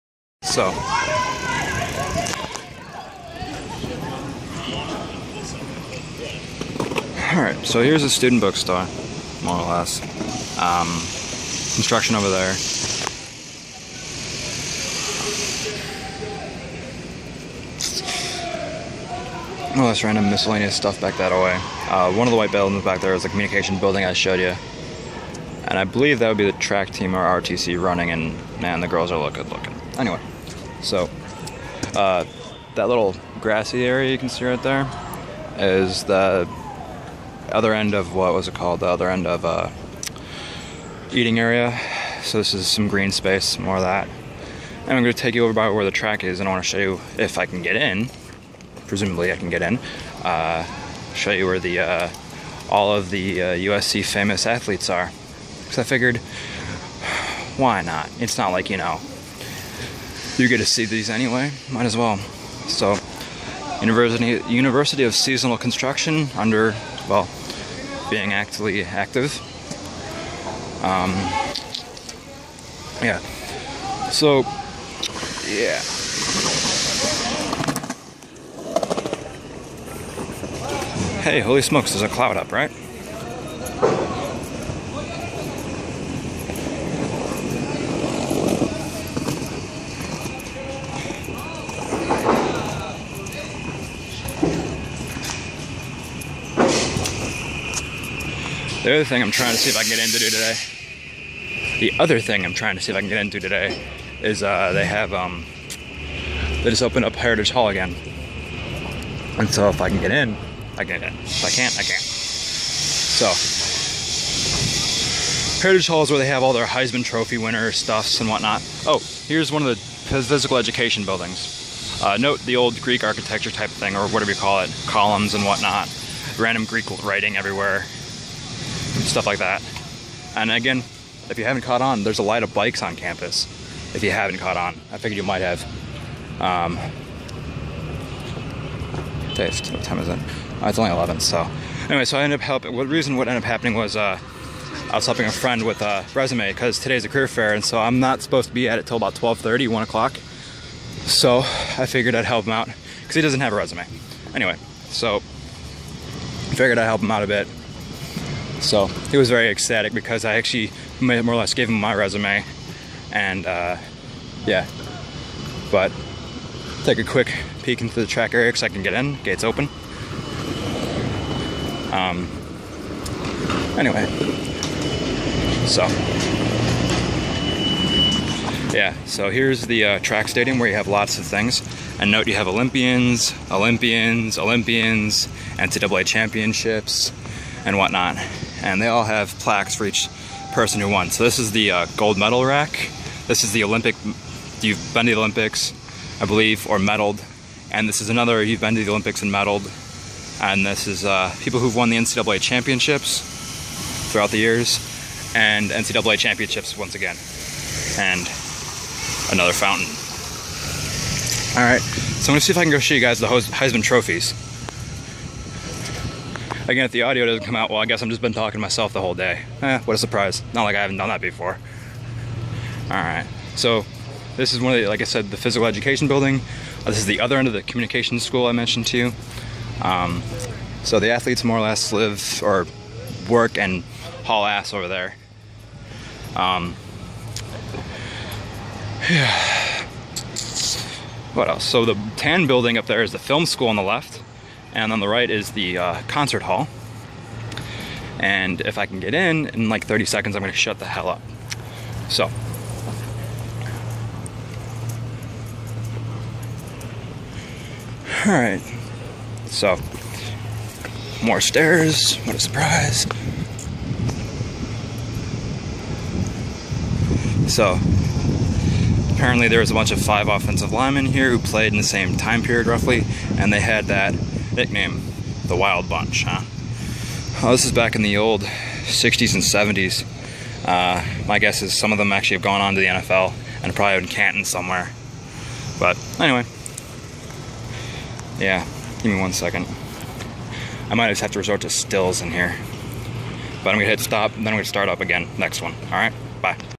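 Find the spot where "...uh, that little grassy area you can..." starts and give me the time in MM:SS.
00:31.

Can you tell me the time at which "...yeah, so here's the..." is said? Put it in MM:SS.
02:58.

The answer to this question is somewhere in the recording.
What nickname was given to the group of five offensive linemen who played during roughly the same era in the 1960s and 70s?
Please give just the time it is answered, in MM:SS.
04:35.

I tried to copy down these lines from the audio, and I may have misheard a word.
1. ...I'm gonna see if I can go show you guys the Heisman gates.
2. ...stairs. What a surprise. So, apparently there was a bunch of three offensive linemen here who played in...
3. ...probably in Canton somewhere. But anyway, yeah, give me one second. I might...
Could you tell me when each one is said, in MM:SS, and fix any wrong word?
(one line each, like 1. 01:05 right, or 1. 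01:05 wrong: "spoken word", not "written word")
1. 03:32 wrong: "trophies", not "gates"
2. 04:21 wrong: "five", not "three"
3. 04:43 right.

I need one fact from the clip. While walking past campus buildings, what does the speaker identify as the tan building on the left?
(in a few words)
film school.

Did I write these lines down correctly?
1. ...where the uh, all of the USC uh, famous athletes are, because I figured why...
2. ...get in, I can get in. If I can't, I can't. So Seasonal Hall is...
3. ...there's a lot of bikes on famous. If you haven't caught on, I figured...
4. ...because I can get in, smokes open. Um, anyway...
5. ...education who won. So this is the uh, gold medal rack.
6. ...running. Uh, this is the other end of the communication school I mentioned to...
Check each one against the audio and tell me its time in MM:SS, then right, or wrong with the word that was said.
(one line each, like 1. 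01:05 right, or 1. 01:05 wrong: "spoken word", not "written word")
1. 00:51 right
2. 01:50 wrong: "Heritage", not "Seasonal"
3. 02:12 wrong: "campus", not "famous"
4. 02:48 wrong: "gates", not "smokes"
5. 03:10 wrong: "person", not "education"
6. 03:46 wrong: "building", not "running".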